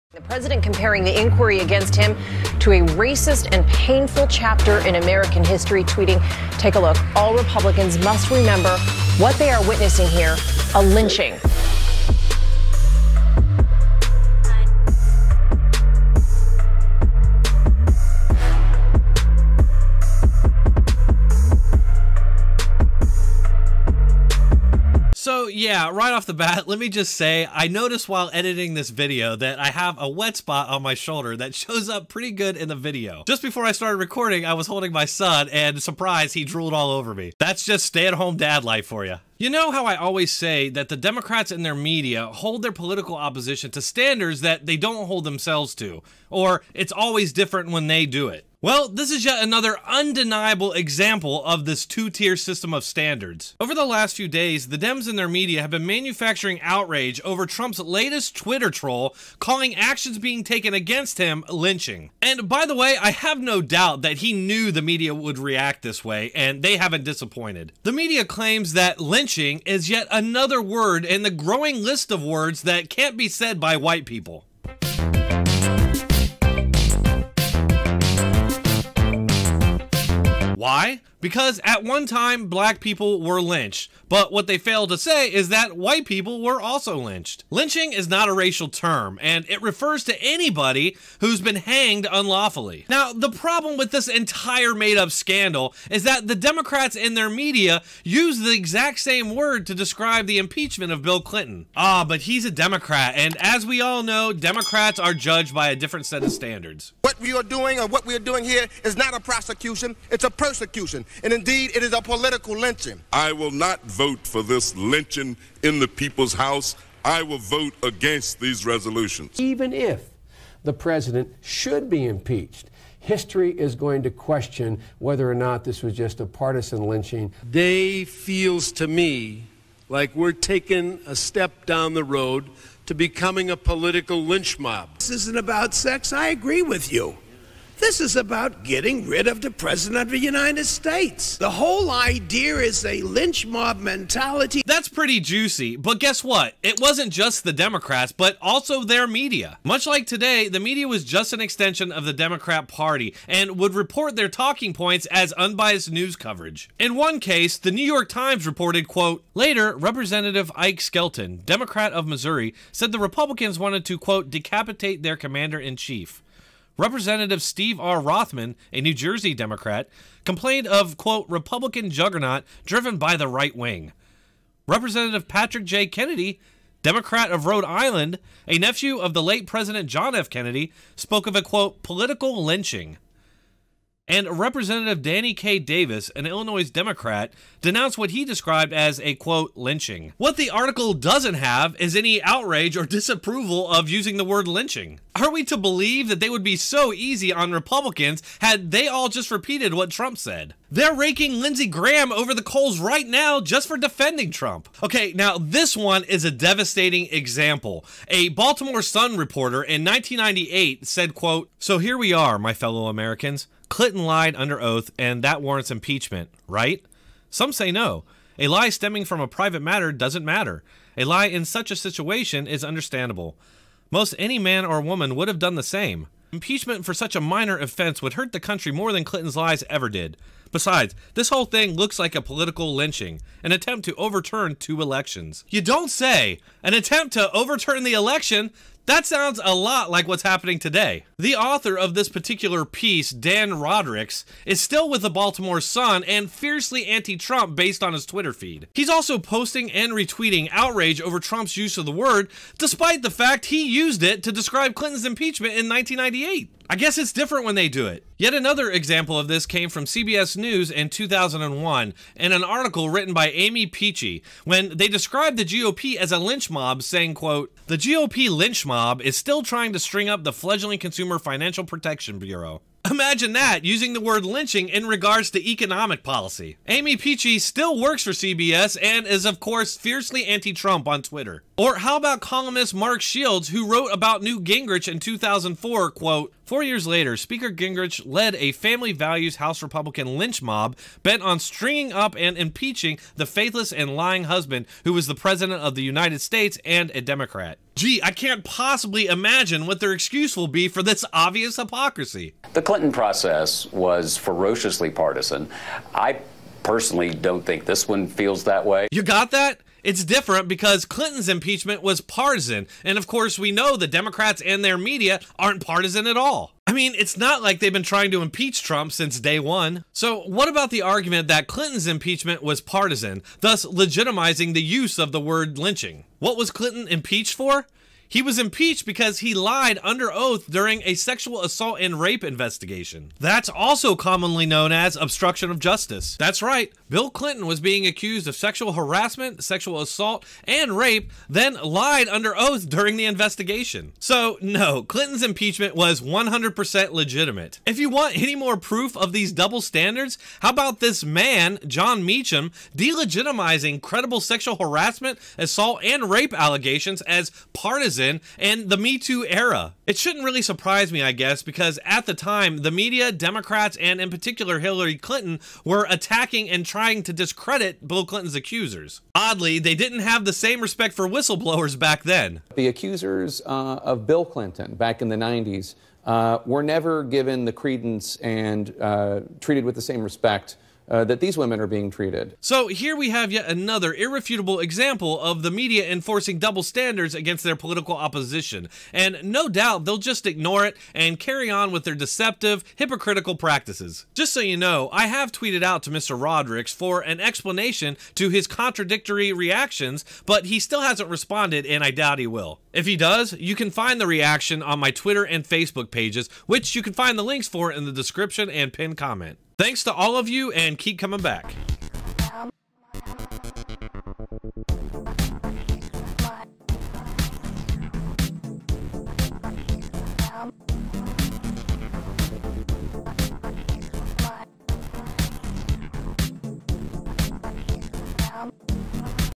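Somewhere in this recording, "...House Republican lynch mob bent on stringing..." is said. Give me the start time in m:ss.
4:49.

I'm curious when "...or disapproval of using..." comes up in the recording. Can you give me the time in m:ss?
3:12.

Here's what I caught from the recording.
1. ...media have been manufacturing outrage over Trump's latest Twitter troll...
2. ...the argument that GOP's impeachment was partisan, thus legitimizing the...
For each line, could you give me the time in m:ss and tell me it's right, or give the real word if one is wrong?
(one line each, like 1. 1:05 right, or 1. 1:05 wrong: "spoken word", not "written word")
1. 0:55 right
2. 5:20 wrong: "Clinton", not "GOP".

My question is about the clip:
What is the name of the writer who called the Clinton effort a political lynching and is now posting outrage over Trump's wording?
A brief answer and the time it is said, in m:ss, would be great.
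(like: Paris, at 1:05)
Dan Rodricks, at 4:03.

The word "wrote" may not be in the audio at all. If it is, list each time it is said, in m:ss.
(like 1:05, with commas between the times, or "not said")
4:43.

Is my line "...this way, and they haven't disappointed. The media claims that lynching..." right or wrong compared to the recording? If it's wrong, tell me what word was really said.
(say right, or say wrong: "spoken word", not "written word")
right.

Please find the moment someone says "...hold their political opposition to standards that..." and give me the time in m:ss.
0:42.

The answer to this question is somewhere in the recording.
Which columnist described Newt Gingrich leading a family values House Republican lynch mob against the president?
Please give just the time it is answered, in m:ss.
4:42.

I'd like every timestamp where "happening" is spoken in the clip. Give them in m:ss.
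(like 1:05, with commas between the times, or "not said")
4:00.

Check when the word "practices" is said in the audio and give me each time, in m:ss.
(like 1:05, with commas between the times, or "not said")
6:33.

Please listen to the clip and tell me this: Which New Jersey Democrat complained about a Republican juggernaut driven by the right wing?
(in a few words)
Steve R. Rothman.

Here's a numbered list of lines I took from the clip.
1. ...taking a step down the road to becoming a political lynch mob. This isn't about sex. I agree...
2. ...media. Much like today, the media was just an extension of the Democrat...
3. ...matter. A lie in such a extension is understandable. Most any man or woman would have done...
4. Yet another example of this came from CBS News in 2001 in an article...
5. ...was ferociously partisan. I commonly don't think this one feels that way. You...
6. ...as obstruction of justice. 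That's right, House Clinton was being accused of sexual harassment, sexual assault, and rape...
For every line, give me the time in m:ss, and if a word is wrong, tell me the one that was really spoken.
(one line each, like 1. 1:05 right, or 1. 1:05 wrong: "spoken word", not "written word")
1. 2:10 right
2. 2:29 right
3. 3:40 wrong: "situation", not "extension"
4. 4:18 right
5. 5:03 wrong: "personally", not "commonly"
6. 5:34 wrong: "Bill", not "House".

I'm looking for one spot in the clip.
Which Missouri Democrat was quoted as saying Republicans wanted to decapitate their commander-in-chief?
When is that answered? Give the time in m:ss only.
2:40.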